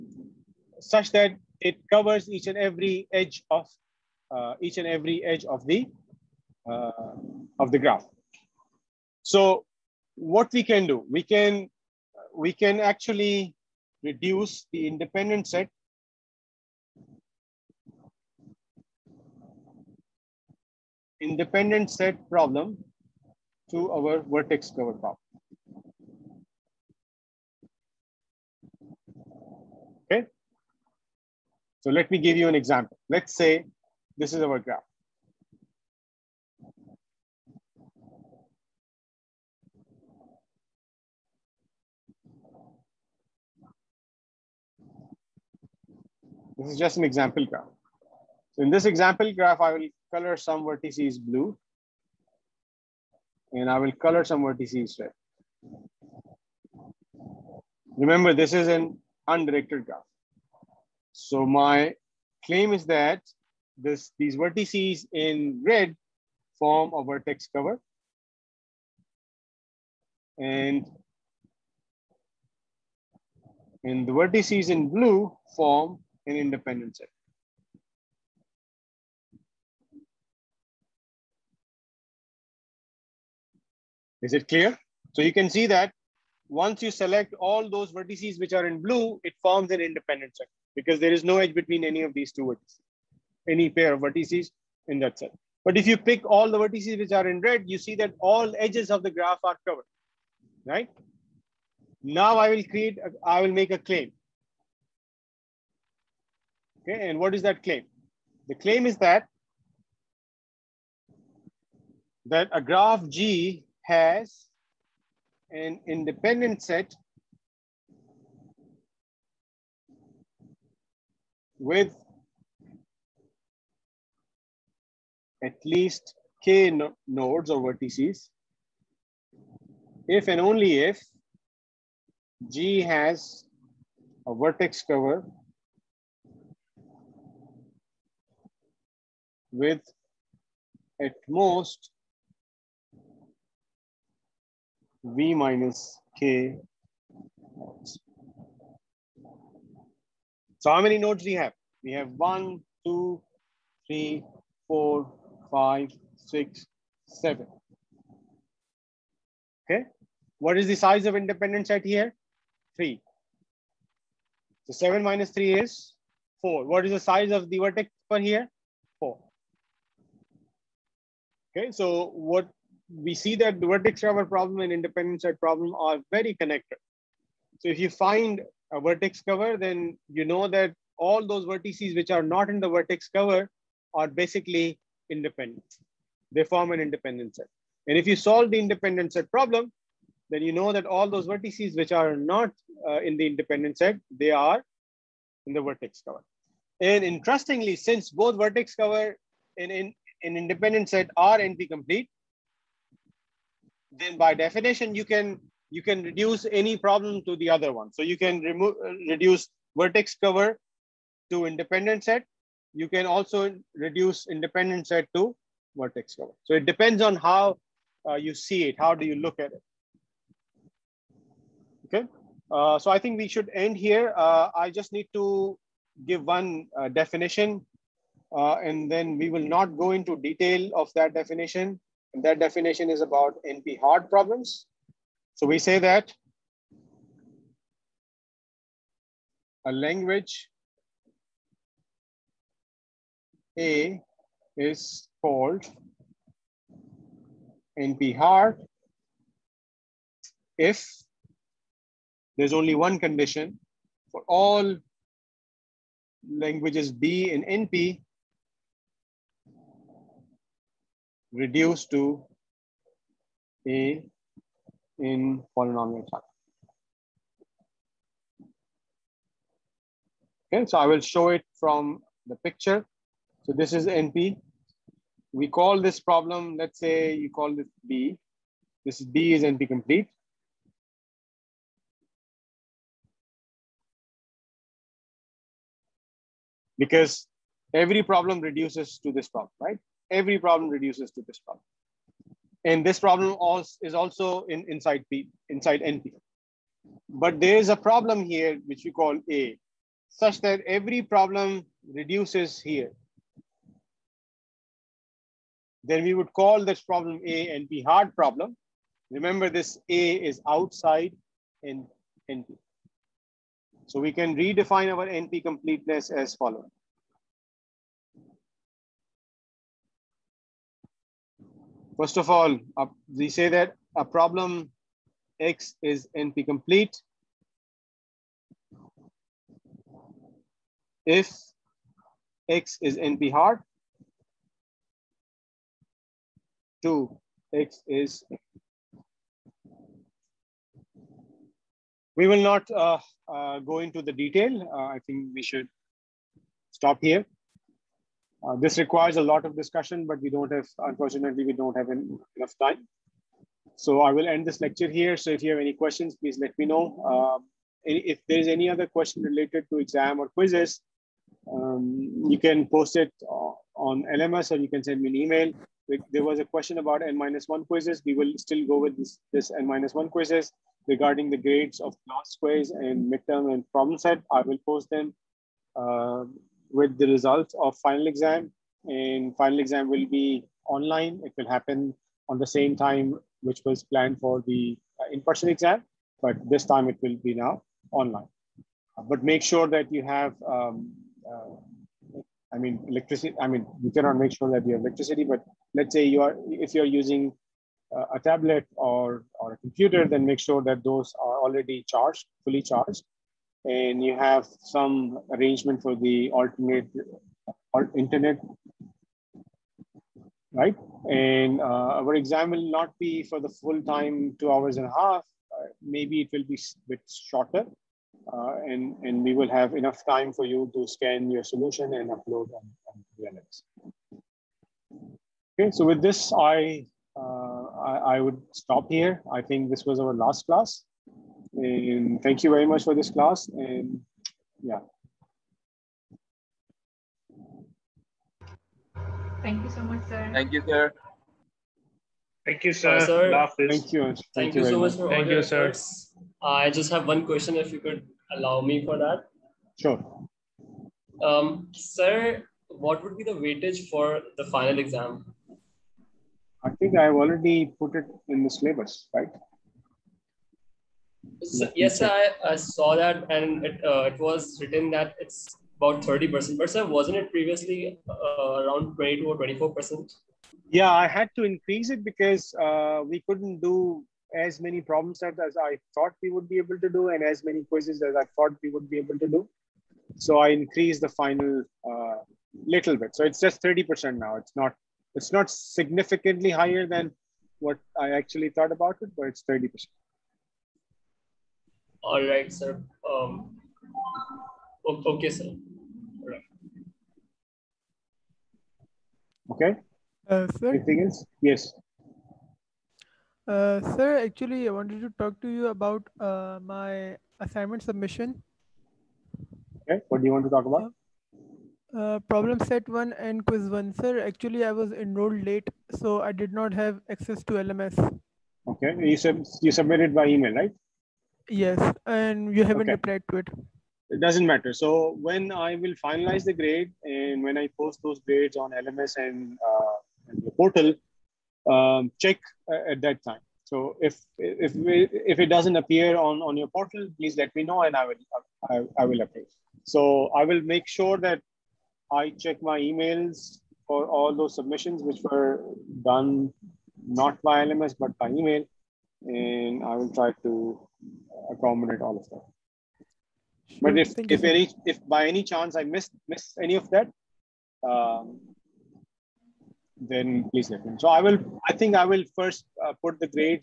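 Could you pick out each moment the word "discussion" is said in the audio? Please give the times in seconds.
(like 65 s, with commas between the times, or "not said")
349 s.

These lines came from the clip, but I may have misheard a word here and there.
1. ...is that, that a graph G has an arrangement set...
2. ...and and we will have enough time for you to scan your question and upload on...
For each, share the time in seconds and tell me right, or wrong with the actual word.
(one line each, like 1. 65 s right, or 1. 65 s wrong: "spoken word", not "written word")
1. 108 s wrong: "independent", not "arrangement"
2. 418 s wrong: "solution", not "question".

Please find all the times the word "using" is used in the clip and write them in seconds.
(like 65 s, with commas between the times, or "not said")
397 s.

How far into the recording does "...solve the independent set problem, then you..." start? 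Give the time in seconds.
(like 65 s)
188 s.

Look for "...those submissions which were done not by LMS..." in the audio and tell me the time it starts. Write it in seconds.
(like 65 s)
544 s.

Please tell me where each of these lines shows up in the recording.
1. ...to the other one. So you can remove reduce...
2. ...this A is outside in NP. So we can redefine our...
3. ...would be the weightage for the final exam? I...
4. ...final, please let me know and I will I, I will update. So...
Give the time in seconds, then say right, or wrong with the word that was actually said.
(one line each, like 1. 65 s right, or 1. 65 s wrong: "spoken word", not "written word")
1. 207 s right
2. 309 s right
3. 453 s right
4. 536 s wrong: "portal", not "final".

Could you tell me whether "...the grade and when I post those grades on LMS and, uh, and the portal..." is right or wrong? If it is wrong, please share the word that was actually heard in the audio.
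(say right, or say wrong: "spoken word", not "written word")
right.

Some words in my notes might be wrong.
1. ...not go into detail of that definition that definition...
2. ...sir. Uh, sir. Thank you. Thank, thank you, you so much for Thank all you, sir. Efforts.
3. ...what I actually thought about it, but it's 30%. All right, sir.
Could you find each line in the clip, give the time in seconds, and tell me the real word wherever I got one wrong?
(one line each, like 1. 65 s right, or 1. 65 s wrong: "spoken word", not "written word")
1. 229 s right
2. 442 s right
3. 487 s right.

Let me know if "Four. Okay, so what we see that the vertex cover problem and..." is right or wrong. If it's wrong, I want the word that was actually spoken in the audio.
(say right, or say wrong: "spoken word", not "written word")
right.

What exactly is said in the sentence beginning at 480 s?
So I increased the final uh, little bit.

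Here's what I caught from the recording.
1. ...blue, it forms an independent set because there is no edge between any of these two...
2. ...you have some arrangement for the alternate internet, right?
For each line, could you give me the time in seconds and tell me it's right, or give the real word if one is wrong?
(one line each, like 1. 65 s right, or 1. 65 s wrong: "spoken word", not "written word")
1. 88 s right
2. 404 s right.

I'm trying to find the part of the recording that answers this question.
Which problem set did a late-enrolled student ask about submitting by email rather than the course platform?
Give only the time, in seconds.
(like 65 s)
512 s.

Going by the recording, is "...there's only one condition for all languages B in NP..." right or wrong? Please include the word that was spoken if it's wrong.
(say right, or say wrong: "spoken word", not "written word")
right.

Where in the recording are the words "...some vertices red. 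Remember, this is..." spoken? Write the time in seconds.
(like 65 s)
54 s.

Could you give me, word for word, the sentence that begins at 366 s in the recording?
There was a question about N-1 quizzes.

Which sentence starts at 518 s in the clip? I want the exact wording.
You, sub you submitted by email, right?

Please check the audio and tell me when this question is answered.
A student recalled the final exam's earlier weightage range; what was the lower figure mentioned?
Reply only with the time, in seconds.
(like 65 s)
468 s.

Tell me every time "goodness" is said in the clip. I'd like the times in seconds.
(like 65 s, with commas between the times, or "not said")
not said.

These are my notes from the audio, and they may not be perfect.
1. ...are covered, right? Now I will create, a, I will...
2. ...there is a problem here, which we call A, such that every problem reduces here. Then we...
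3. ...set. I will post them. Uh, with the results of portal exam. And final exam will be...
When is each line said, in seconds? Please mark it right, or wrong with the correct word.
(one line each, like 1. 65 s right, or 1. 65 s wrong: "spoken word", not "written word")
1. 99 s right
2. 297 s right
3. 373 s wrong: "final", not "portal".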